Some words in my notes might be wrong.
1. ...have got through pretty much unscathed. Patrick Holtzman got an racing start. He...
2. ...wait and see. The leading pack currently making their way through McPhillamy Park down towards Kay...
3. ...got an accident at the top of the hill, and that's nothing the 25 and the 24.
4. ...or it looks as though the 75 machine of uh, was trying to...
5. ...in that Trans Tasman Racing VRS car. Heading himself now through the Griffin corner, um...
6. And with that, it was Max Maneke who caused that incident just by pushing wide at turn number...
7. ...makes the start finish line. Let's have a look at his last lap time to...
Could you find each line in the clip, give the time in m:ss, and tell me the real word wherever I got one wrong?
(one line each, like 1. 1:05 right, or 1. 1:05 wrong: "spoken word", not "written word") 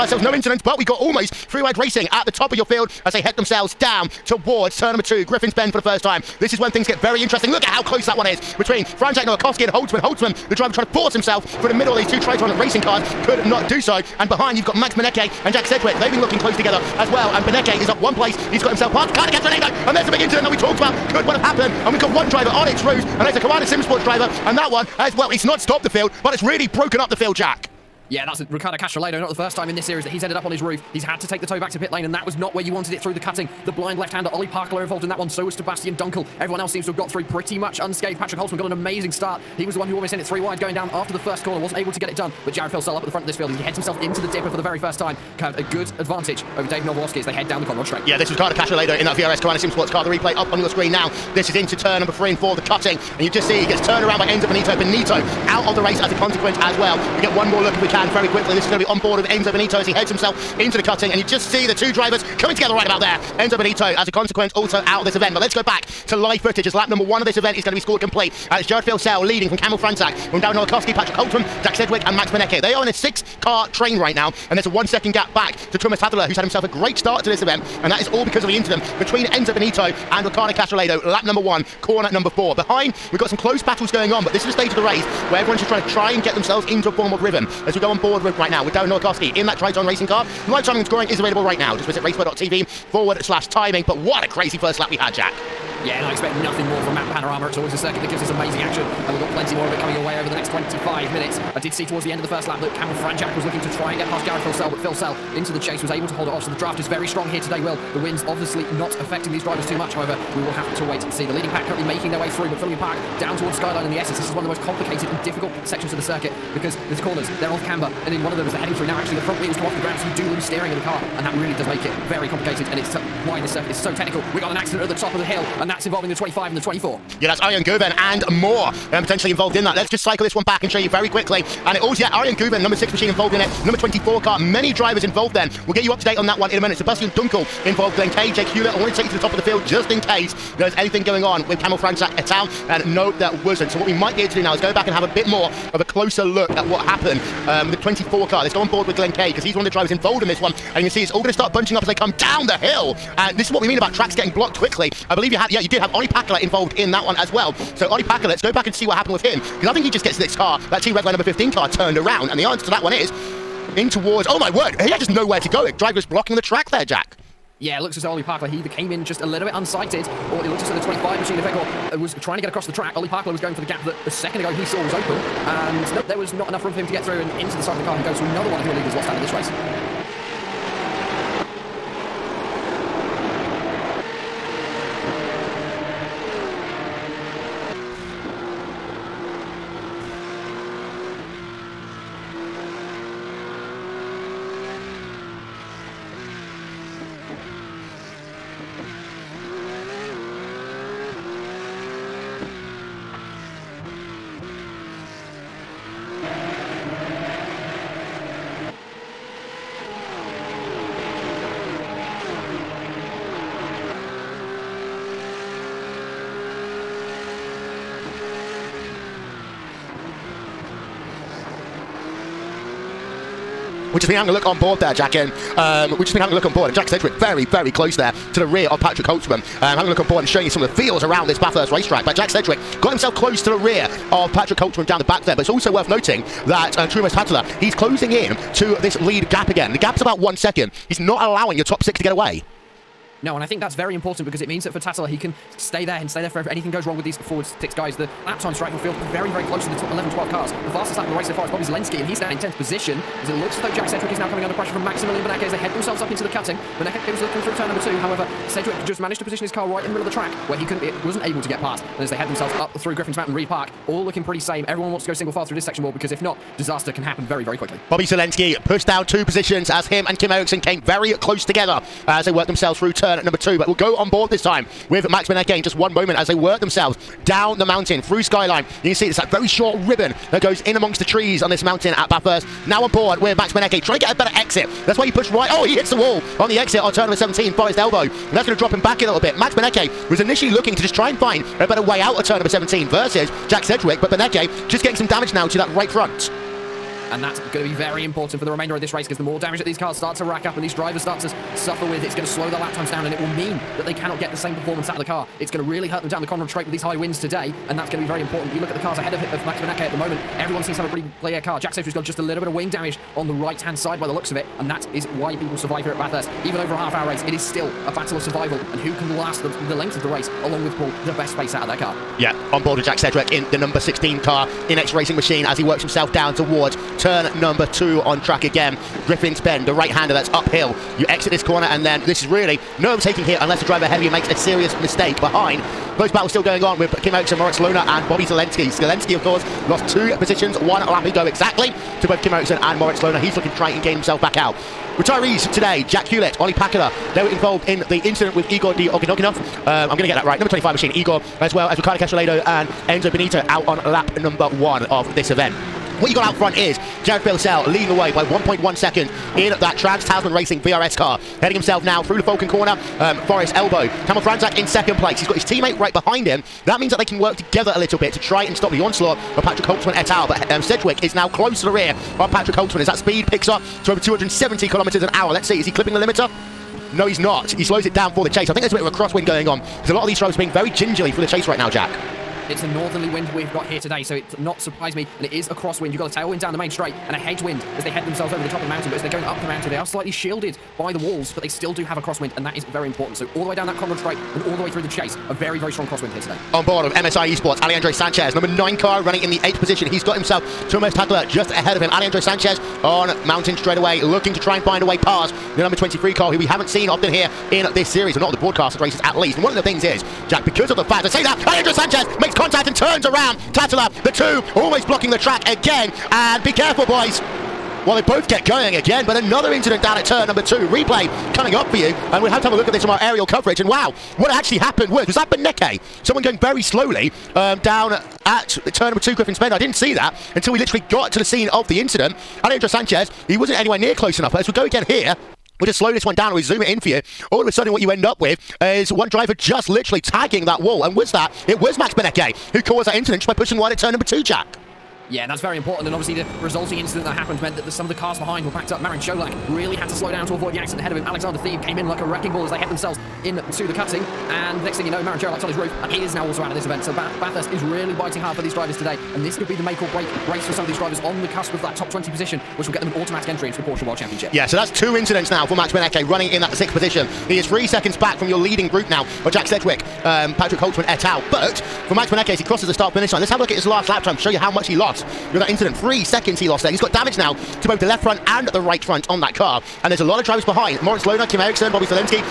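1. 0:36 wrong: "amazing", not "racing"
2. 1:50 wrong: "Skyline", not "Kay"
3. 2:04 wrong: "involving", not "nothing"
4. 2:50 wrong: "25", not "75"
5. 5:59 wrong: "Falcon", not "Griffin"
6. 7:20 wrong: "Benecke", not "Maneke"
7. 7:52 wrong: "crosses", not "makes".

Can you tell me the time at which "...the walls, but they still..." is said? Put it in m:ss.
6:30.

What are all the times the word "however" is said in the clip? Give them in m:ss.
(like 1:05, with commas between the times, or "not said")
1:49, 4:18.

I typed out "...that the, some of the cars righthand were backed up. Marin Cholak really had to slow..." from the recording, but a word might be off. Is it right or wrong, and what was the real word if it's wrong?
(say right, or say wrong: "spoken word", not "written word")
wrong: "behind", not "righthand".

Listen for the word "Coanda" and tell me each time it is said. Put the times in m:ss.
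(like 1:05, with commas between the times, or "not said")
0:23, 0:49.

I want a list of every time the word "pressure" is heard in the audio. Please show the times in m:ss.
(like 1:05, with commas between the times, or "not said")
4:14.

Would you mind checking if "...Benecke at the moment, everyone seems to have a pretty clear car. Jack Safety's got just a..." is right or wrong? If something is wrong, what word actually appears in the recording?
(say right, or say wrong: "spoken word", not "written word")
right.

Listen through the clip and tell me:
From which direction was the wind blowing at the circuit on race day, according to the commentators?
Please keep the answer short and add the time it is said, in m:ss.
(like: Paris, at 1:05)
Northerly, at 6:22.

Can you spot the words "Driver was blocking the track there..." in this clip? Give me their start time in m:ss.
2:45.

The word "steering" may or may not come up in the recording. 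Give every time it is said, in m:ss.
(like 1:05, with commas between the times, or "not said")
2:00.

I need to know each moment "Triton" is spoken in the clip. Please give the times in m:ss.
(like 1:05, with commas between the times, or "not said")
0:12, 1:29.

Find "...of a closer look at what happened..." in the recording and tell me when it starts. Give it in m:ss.
2:25.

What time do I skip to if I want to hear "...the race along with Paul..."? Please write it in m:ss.
5:20.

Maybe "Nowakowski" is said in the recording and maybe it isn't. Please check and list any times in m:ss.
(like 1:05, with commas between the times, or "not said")
0:09, 1:10, 1:28.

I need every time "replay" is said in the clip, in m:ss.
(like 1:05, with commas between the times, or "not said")
0:50, 7:00.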